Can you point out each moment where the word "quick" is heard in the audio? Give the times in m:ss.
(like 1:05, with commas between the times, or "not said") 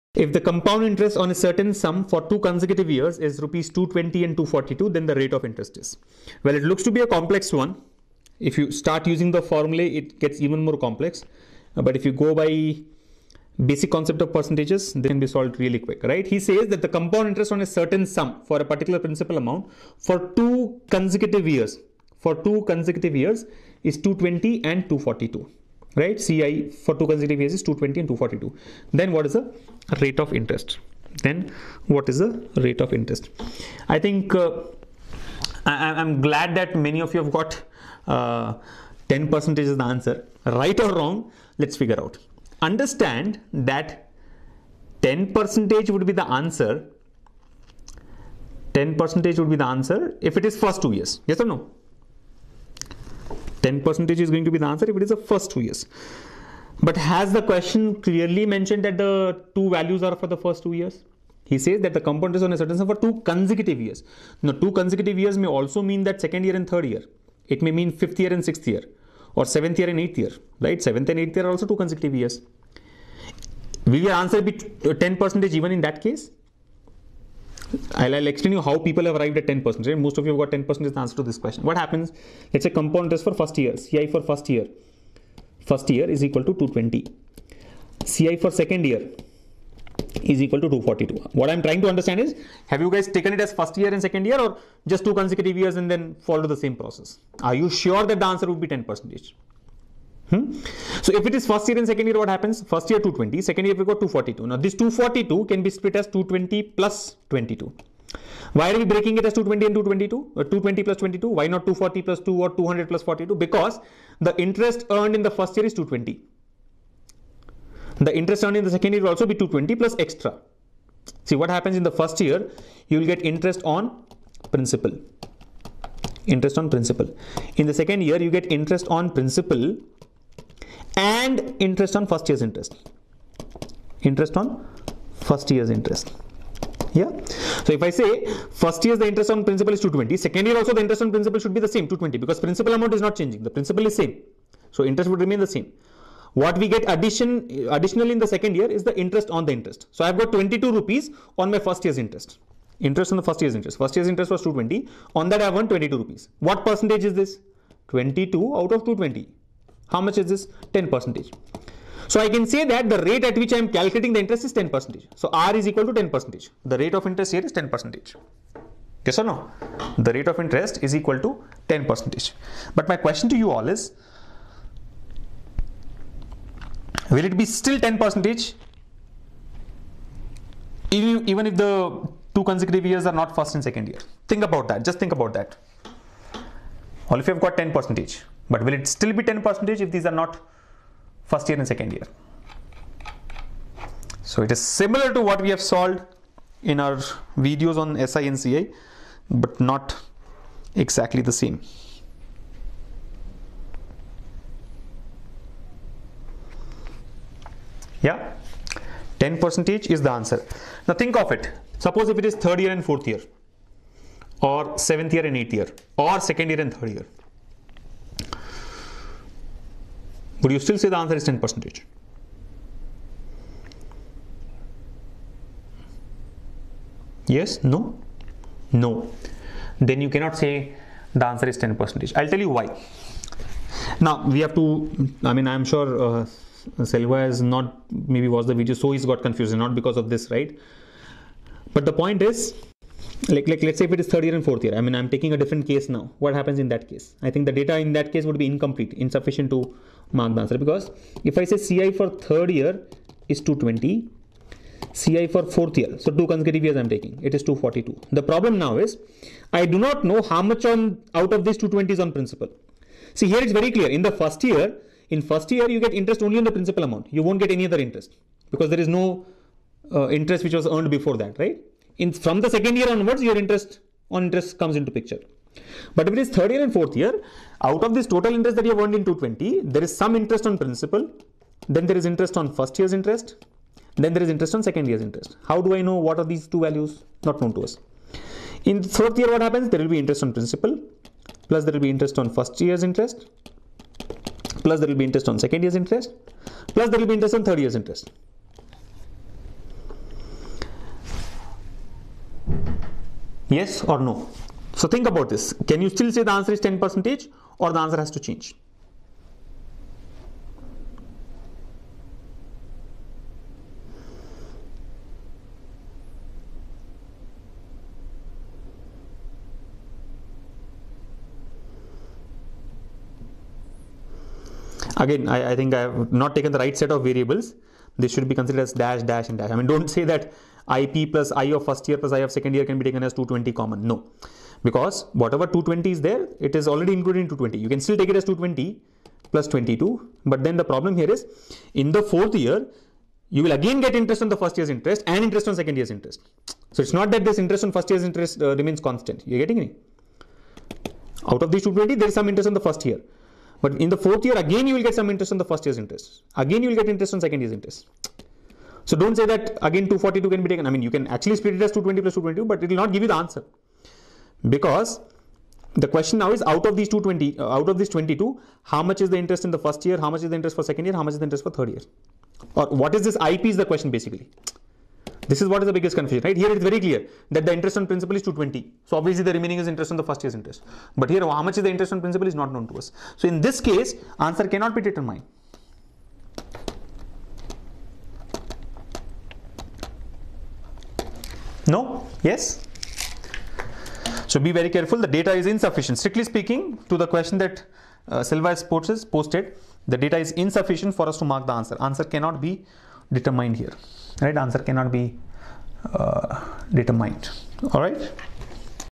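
0:15.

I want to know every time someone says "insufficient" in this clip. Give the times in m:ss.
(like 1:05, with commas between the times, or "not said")
4:08, 6:35, 6:40.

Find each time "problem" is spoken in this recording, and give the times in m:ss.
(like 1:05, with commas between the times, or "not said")
4:18, 5:40.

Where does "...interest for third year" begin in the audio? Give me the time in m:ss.
6:11.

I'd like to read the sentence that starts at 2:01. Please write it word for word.
See what happens in the first year, you will get interest on principal.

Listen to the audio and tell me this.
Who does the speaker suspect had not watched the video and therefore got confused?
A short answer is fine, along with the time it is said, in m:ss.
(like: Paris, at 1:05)
Selva, at 3:56.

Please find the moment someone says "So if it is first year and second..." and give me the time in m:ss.
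1:41.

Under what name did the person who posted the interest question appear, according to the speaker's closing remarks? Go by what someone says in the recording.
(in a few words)
Silva Sports.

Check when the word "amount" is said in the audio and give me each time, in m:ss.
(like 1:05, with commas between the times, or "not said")
0:19, 2:22, 4:26.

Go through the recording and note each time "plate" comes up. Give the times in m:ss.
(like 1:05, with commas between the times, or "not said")
not said.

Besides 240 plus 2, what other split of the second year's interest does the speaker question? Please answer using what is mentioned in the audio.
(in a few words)
200 plus 42.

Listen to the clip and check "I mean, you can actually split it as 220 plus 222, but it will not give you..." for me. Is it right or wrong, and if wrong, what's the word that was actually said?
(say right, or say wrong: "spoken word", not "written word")
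right.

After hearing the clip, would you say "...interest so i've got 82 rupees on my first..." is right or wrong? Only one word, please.
wrong.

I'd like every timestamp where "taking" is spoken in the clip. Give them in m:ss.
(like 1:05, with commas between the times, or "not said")
4:05, 4:16.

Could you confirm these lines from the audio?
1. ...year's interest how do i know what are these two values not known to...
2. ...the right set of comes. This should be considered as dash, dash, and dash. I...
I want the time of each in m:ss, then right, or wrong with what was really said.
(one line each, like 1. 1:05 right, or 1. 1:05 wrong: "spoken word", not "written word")
1. 4:44 right
2. 5:26 wrong: "variables", not "comes".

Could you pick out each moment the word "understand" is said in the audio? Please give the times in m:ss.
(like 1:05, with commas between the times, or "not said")
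0:42, 1:31.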